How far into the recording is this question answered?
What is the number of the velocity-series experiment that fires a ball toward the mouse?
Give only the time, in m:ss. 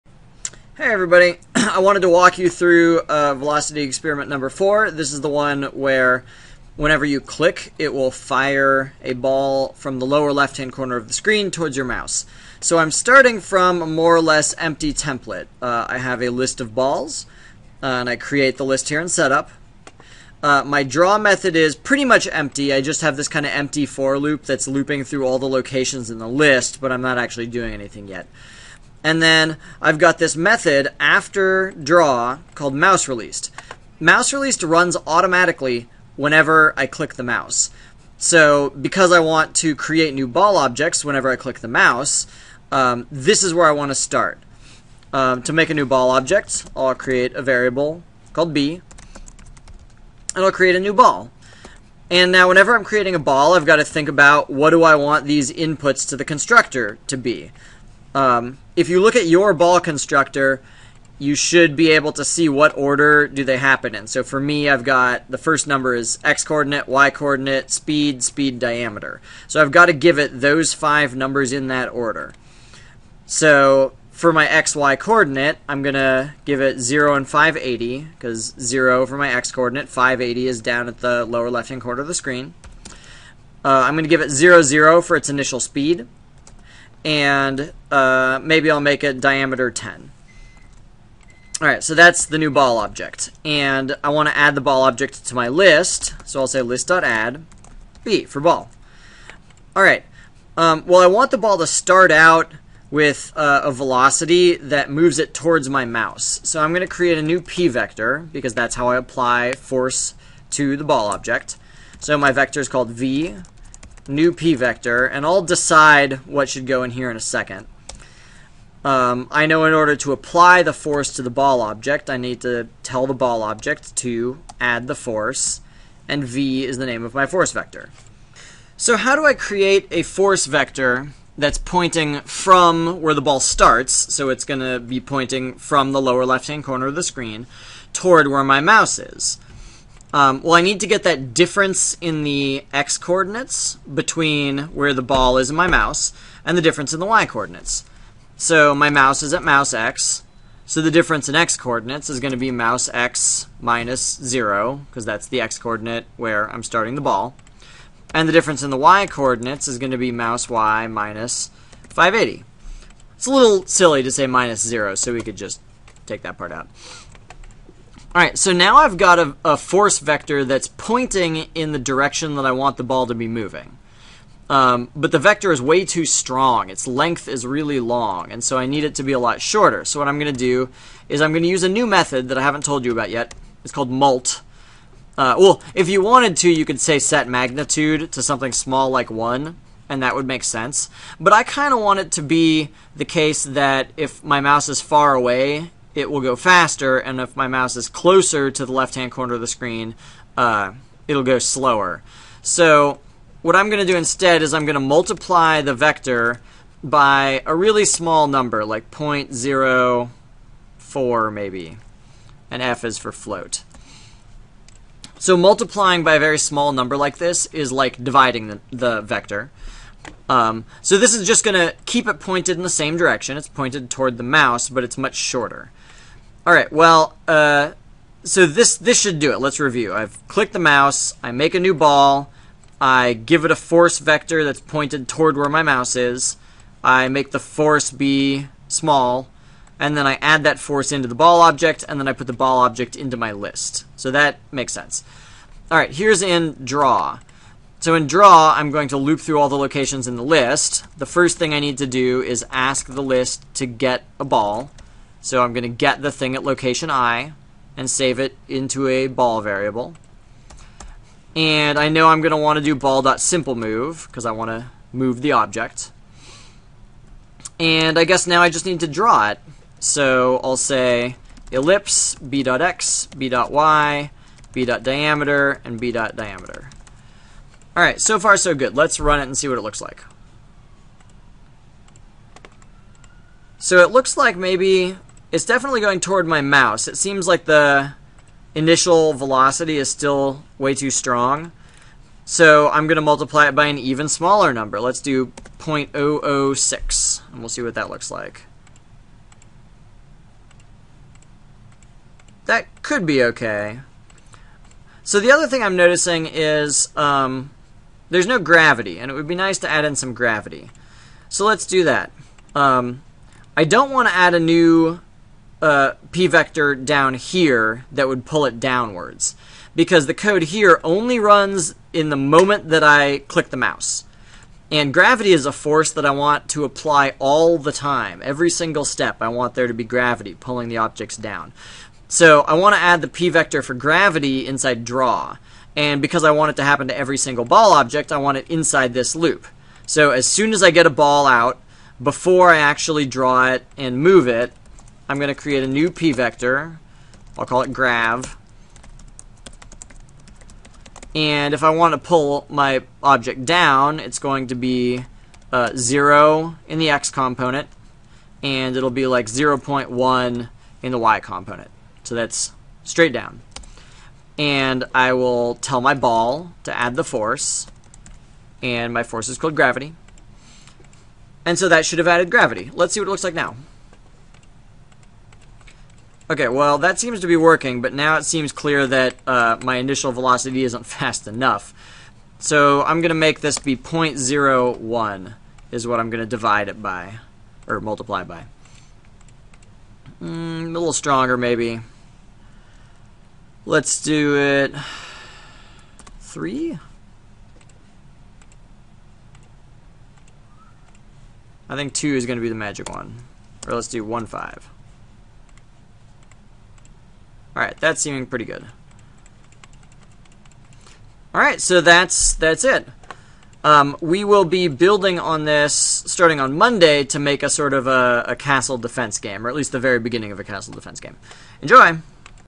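0:04.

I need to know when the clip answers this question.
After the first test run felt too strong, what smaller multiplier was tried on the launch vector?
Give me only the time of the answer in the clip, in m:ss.
4:55.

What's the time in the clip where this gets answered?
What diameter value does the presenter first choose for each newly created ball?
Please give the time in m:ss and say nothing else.
1:29.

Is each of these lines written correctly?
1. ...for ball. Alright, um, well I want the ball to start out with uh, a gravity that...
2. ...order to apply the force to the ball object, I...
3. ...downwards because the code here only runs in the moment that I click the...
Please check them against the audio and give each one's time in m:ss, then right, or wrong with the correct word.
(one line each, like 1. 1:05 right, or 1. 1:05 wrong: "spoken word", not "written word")
1. 1:38 wrong: "velocity", not "gravity"
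2. 1:59 right
3. 5:18 right.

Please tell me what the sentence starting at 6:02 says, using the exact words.
So that's straight down and I will tell my ball to add the force, and my force is called gravity.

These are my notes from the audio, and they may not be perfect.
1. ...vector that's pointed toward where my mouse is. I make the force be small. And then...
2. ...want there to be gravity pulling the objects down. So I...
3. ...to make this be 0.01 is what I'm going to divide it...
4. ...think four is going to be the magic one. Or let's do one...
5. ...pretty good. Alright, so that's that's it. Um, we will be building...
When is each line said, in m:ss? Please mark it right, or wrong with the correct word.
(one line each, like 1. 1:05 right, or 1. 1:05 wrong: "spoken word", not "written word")
1. 3:53 right
2. 5:29 right
3. 6:23 right
4. 6:41 wrong: "two", not "four"
5. 6:48 right.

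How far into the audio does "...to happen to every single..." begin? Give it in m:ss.
5:36.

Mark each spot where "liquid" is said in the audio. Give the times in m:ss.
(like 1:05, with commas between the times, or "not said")
not said.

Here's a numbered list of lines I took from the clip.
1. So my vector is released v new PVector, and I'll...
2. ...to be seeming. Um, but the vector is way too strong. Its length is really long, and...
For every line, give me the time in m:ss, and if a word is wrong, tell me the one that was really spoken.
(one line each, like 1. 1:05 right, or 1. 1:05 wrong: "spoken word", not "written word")
1. 1:51 wrong: "called", not "released"
2. 2:53 wrong: "moving", not "seeming".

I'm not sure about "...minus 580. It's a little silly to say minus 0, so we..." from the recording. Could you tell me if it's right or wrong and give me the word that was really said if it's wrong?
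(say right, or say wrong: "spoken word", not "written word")
right.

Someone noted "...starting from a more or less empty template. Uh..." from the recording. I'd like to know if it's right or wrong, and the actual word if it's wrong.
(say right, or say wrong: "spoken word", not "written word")
right.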